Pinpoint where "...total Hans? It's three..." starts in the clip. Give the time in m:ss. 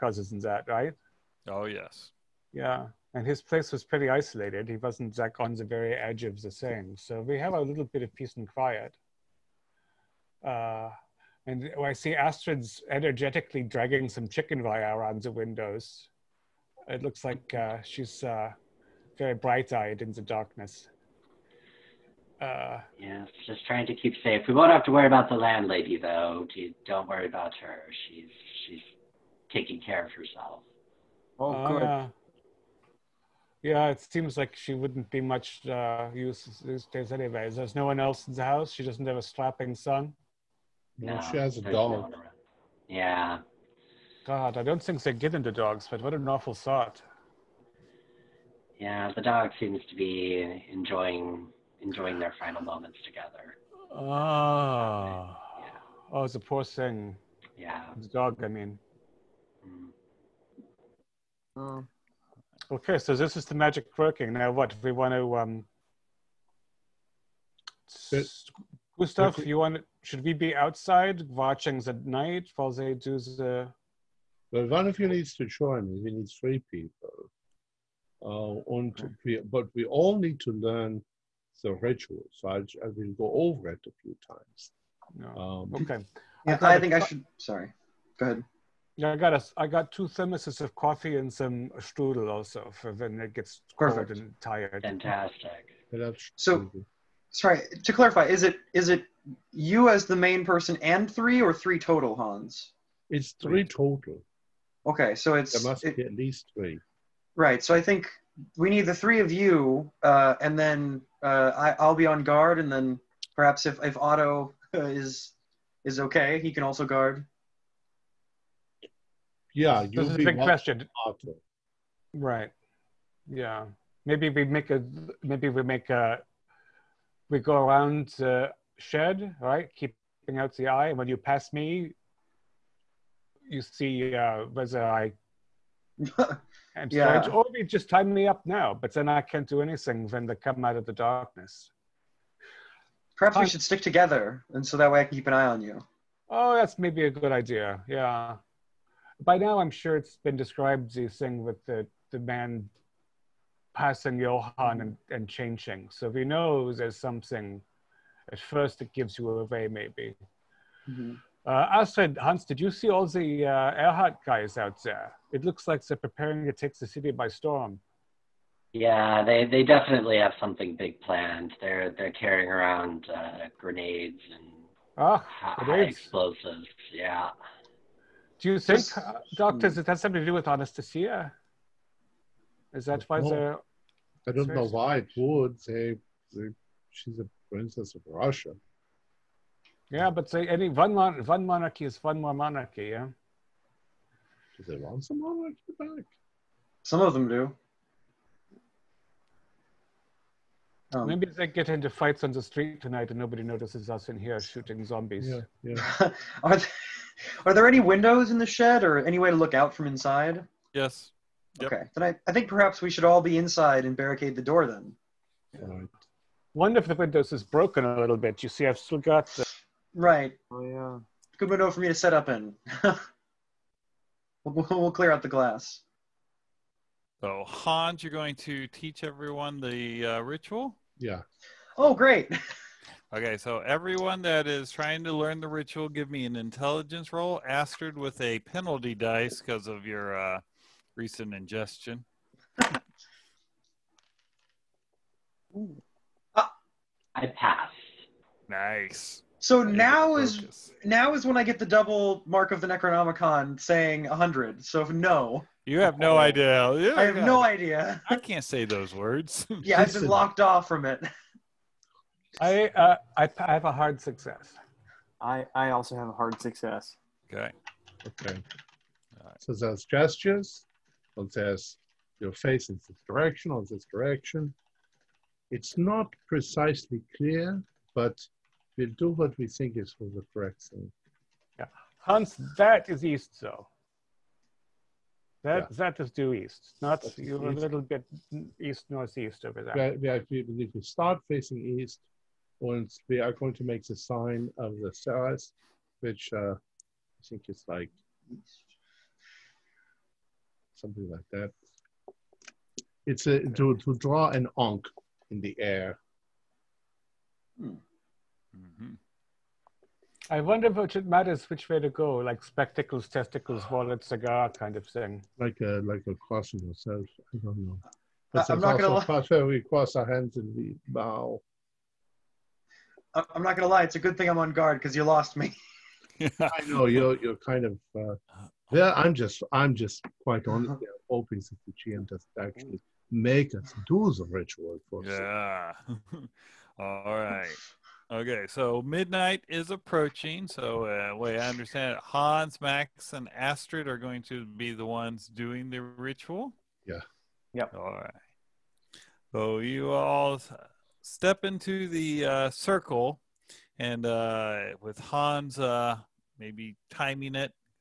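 1:41.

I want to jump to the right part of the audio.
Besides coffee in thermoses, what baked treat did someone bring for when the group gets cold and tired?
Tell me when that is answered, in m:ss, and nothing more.
1:31.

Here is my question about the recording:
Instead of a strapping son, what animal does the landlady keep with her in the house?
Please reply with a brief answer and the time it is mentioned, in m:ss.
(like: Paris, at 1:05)
A dog, at 0:41.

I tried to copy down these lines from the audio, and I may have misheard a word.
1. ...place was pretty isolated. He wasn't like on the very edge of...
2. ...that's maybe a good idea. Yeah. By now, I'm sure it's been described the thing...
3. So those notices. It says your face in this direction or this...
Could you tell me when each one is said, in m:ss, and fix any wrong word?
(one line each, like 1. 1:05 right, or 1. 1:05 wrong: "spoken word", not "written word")
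1. 0:03 right
2. 2:26 right
3. 4:29 wrong: "gestures", not "notices".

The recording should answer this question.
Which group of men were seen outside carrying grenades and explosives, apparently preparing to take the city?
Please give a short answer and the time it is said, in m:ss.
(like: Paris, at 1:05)
Ehrhardt guys, at 2:43.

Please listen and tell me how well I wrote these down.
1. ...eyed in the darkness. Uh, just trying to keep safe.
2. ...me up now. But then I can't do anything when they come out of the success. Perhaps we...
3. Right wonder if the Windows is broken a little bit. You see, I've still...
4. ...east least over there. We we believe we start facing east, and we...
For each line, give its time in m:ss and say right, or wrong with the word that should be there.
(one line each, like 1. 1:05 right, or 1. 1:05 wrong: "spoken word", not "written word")
1. 0:19 right
2. 2:18 wrong: "darkness", not "success"
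3. 3:35 right
4. 4:48 wrong: "northeast", not "least".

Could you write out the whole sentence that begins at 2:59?
has something to do with Anastasia?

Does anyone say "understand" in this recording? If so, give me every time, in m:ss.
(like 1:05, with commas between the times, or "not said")
5:41.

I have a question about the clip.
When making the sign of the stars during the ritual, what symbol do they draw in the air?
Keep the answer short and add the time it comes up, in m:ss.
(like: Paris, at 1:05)
An ankh, at 5:04.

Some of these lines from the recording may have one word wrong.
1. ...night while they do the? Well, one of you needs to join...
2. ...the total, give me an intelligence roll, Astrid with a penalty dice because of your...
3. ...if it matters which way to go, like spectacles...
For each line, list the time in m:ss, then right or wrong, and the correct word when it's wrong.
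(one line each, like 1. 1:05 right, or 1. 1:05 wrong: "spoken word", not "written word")
1. 1:12 right
2. 3:55 wrong: "ritual", not "total"
3. 5:10 right.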